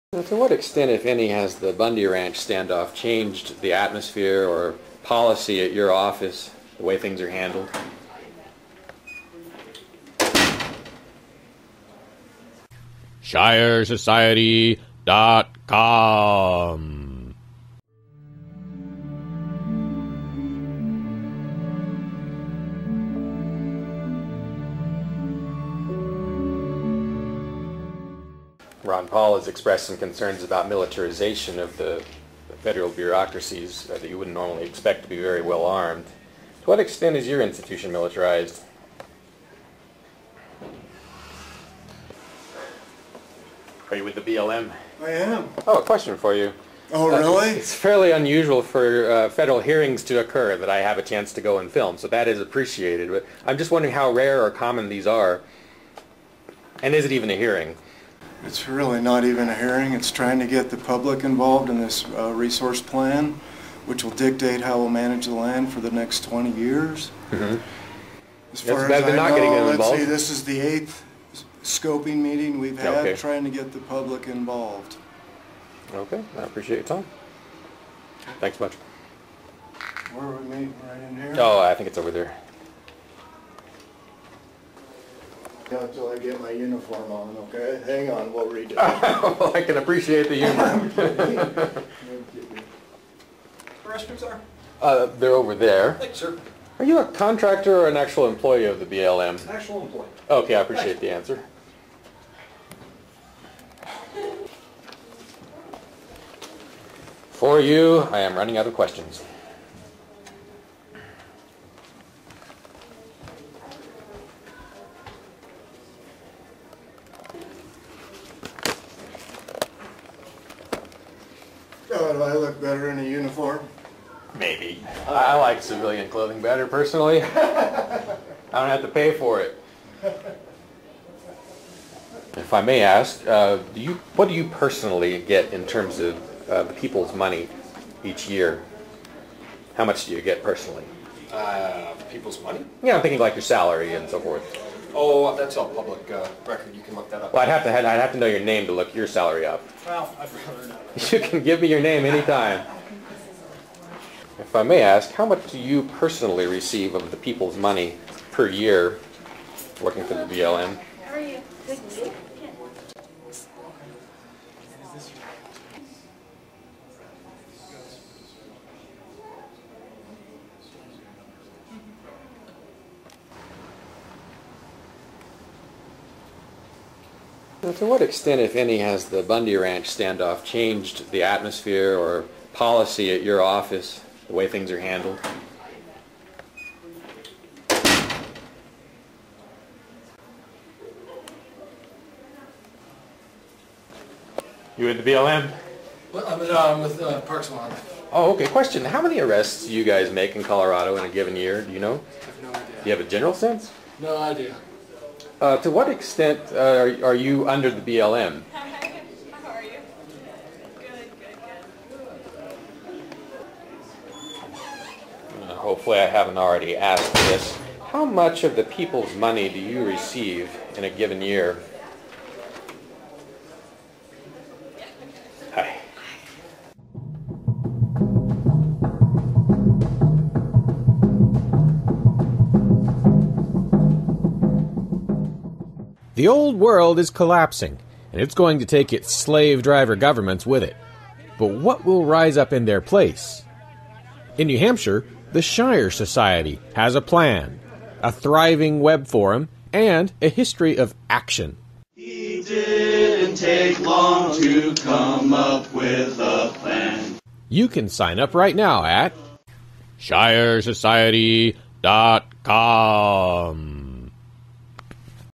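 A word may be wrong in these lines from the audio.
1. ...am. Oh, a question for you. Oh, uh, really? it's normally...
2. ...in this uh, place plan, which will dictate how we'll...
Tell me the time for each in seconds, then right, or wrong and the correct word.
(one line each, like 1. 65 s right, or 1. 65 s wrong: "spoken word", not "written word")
1. 45 s wrong: "fairly", not "normally"
2. 61 s wrong: "resource", not "place".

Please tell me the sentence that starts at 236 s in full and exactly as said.
The old world is collapsing, and it's going to take its slave driver governments with it.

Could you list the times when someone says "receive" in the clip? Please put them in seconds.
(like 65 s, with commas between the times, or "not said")
156 s, 219 s.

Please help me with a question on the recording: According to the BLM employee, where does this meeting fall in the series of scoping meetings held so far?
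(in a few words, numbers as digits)
eighth.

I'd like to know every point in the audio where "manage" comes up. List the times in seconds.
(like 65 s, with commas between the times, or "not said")
64 s.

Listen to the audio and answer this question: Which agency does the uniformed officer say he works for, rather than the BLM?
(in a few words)
Parks and Wildlife.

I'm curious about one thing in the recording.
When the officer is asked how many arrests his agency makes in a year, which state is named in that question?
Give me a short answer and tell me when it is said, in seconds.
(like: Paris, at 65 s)
Colorado, at 200 s.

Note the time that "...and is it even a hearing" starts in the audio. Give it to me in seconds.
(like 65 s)
56 s.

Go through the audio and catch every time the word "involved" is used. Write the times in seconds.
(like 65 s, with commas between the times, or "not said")
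61 s, 74 s.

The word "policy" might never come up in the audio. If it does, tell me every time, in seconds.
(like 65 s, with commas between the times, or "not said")
5 s, 182 s.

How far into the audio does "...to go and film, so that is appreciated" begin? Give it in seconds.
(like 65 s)
51 s.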